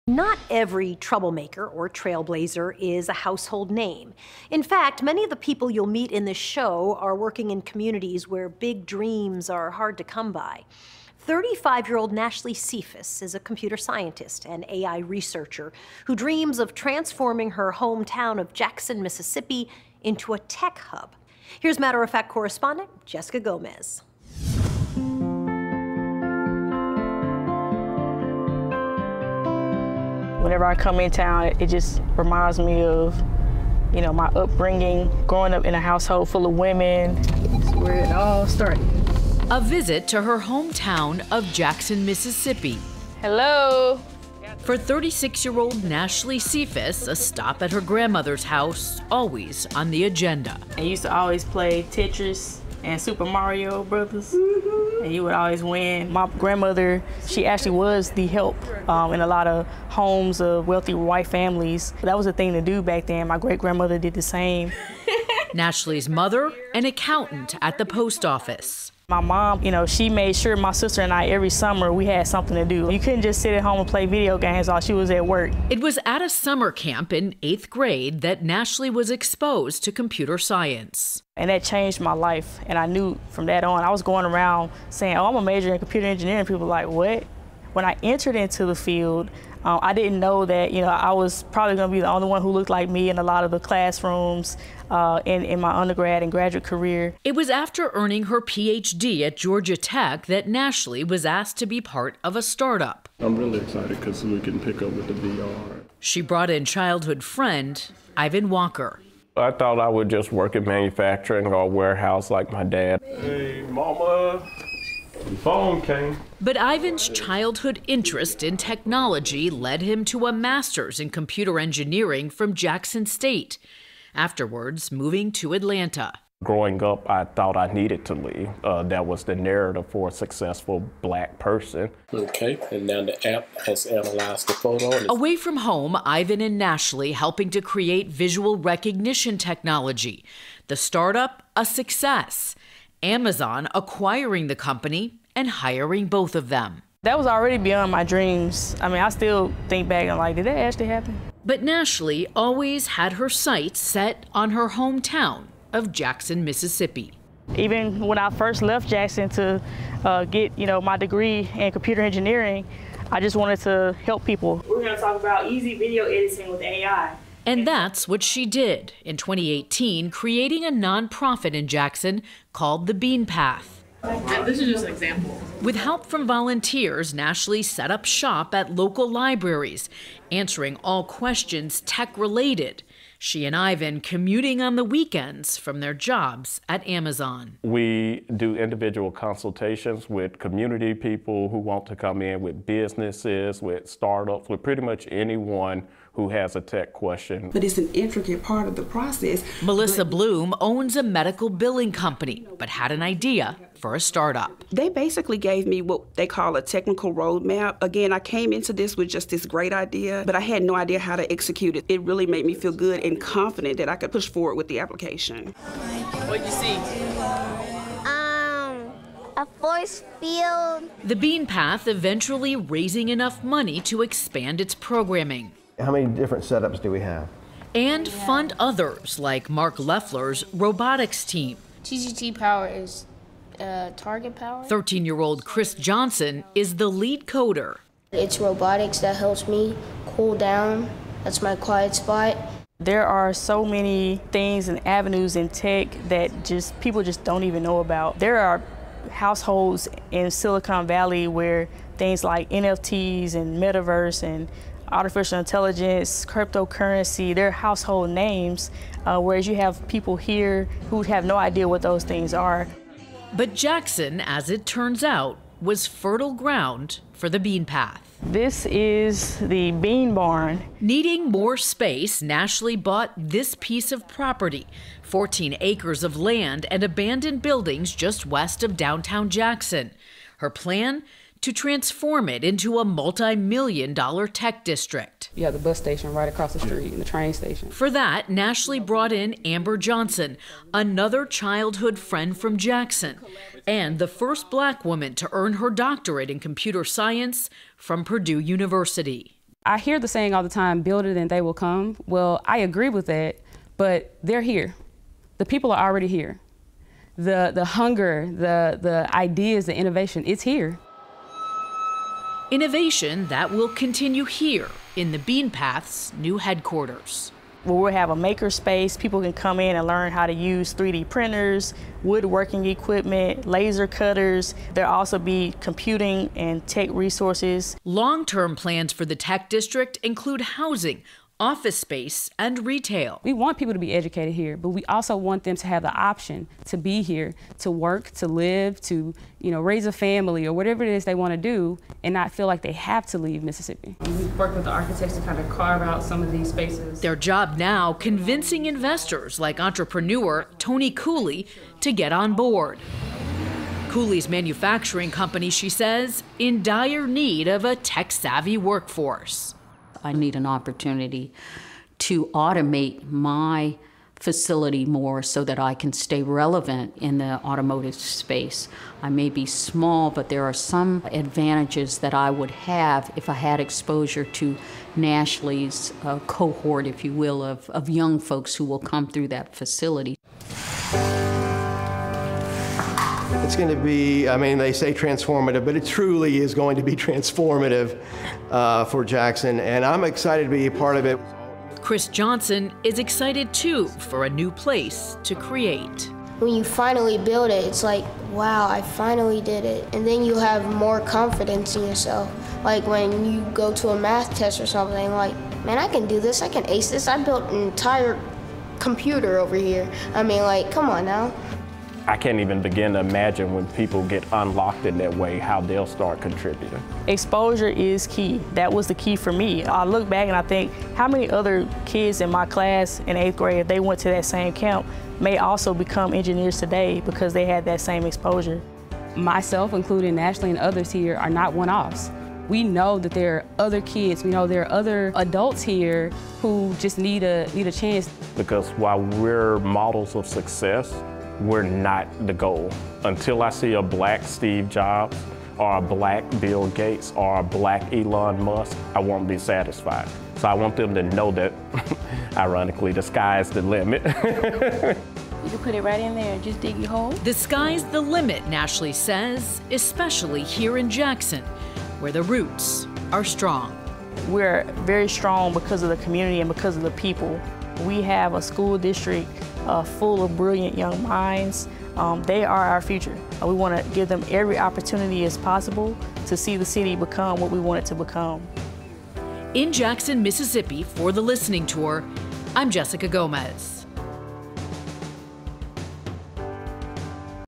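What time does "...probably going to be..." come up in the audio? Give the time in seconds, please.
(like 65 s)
91 s.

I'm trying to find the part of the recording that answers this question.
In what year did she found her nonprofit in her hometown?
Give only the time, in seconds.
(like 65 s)
169 s.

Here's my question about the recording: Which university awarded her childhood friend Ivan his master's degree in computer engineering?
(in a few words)
Jackson State.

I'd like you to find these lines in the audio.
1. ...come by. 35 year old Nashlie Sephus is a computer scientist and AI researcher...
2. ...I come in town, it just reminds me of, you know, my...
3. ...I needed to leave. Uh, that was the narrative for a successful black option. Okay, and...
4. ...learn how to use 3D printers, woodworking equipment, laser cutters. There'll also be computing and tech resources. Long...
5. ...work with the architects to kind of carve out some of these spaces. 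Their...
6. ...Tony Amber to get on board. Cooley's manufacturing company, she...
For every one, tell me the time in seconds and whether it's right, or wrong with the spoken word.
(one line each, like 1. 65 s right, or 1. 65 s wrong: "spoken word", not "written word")
1. 10 s right
2. 30 s right
3. 127 s wrong: "person", not "option"
4. 319 s right
5. 344 s right
6. 350 s wrong: "Cooley", not "Amber".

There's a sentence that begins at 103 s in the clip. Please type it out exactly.
I'm really excited because we can pick up with the VR.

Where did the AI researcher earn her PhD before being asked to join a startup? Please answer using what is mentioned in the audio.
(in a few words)
Georgia Tech.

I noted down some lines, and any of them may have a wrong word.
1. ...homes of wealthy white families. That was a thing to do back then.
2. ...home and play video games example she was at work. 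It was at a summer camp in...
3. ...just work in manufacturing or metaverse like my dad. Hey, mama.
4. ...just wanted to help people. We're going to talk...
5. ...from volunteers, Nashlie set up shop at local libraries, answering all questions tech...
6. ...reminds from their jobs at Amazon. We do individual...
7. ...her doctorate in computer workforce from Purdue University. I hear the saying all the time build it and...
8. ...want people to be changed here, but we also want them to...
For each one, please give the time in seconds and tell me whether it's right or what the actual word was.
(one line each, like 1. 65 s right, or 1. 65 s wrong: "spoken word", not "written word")
1. 59 s right
2. 73 s wrong: "while", not "example"
3. 110 s wrong: "warehouse", not "metaverse"
4. 163 s right
5. 176 s right
6. 184 s wrong: "weekends", not "reminds"
7. 295 s wrong: "science", not "workforce"
8. 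333 s wrong: "educated", not "changed".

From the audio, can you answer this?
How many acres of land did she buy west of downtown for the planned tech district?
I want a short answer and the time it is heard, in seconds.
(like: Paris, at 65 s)
14 acres, at 275 s.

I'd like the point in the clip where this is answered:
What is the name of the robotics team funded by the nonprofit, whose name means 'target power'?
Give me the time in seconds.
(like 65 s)
231 s.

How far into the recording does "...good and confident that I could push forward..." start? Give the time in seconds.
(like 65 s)
212 s.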